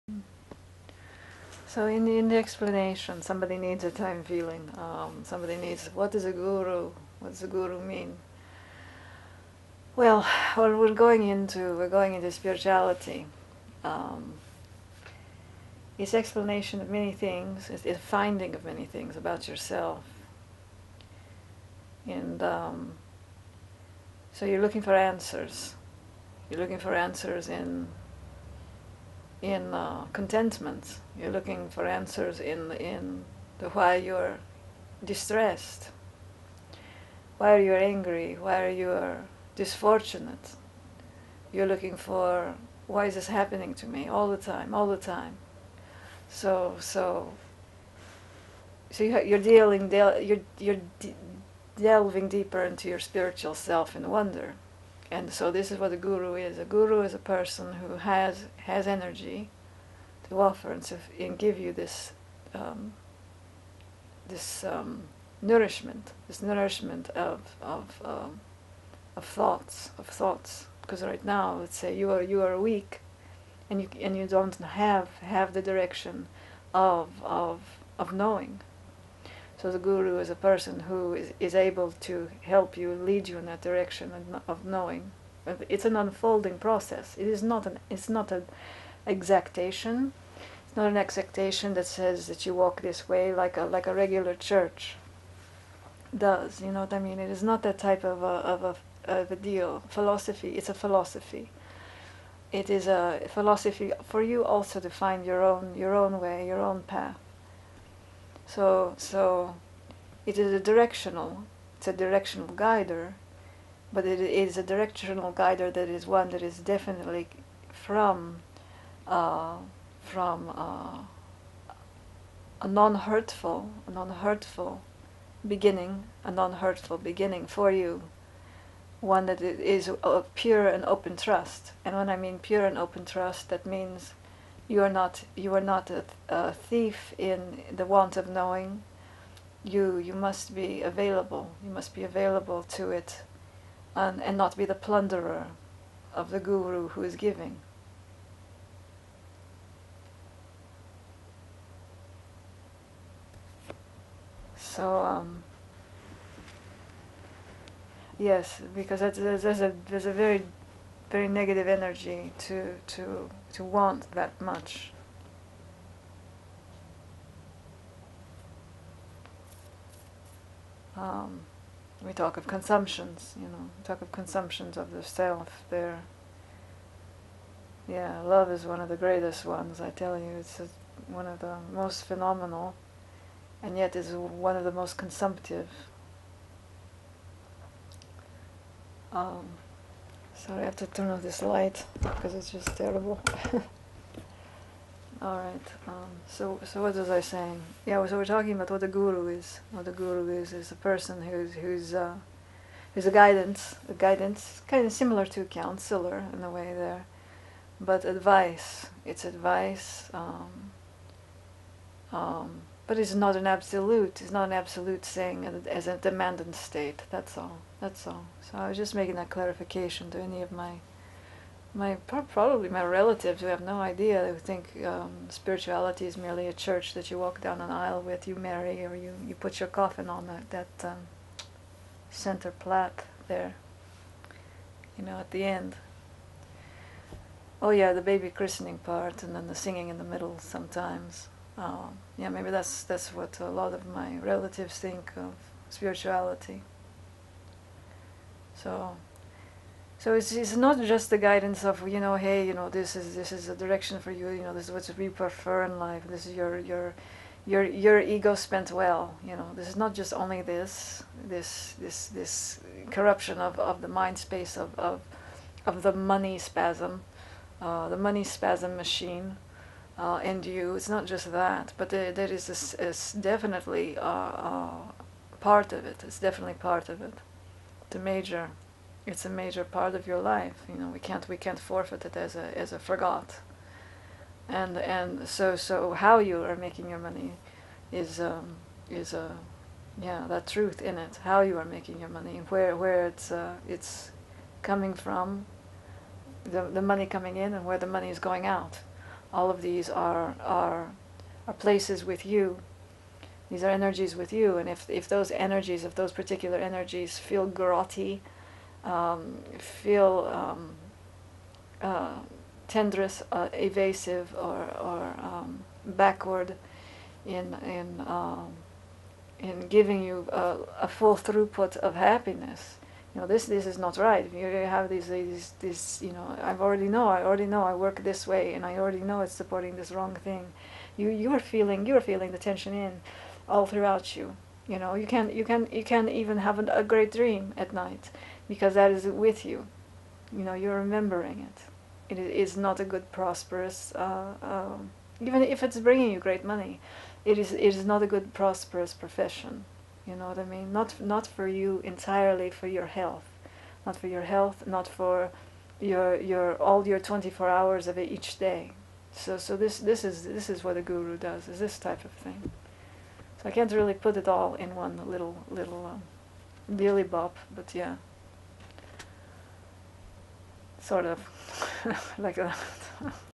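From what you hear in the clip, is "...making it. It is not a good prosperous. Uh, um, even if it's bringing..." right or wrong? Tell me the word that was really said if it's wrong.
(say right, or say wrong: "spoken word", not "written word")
wrong: "remembering", not "making".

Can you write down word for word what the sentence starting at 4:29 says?
Uh, and you, it's not just that, but there, there is, this is definitely uh, uh, part of it.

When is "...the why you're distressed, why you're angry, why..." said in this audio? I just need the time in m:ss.
0:33.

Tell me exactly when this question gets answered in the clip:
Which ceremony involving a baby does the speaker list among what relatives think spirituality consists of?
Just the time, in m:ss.
3:58.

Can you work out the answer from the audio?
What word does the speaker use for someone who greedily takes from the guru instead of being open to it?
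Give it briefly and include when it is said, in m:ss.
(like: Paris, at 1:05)
Plunderer, at 2:24.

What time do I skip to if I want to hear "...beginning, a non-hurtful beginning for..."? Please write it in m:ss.
2:05.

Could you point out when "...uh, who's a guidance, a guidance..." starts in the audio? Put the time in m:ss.
3:21.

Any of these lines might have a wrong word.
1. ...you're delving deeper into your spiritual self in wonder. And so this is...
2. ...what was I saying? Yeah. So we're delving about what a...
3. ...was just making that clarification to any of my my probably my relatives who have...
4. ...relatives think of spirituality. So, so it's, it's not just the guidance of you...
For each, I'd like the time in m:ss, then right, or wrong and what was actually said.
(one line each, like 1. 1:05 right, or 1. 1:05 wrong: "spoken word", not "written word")
1. 0:50 right
2. 3:16 wrong: "talking", not "delving"
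3. 3:38 right
4. 4:04 right.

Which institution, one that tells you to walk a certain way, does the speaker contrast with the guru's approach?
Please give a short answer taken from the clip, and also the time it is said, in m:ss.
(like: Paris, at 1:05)
A regular church, at 1:33.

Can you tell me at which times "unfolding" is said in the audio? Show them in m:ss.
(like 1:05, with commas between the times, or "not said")
1:25.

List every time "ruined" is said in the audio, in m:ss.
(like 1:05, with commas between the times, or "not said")
not said.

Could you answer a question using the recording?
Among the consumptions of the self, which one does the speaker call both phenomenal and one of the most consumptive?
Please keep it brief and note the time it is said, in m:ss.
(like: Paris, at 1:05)
Love, at 2:58.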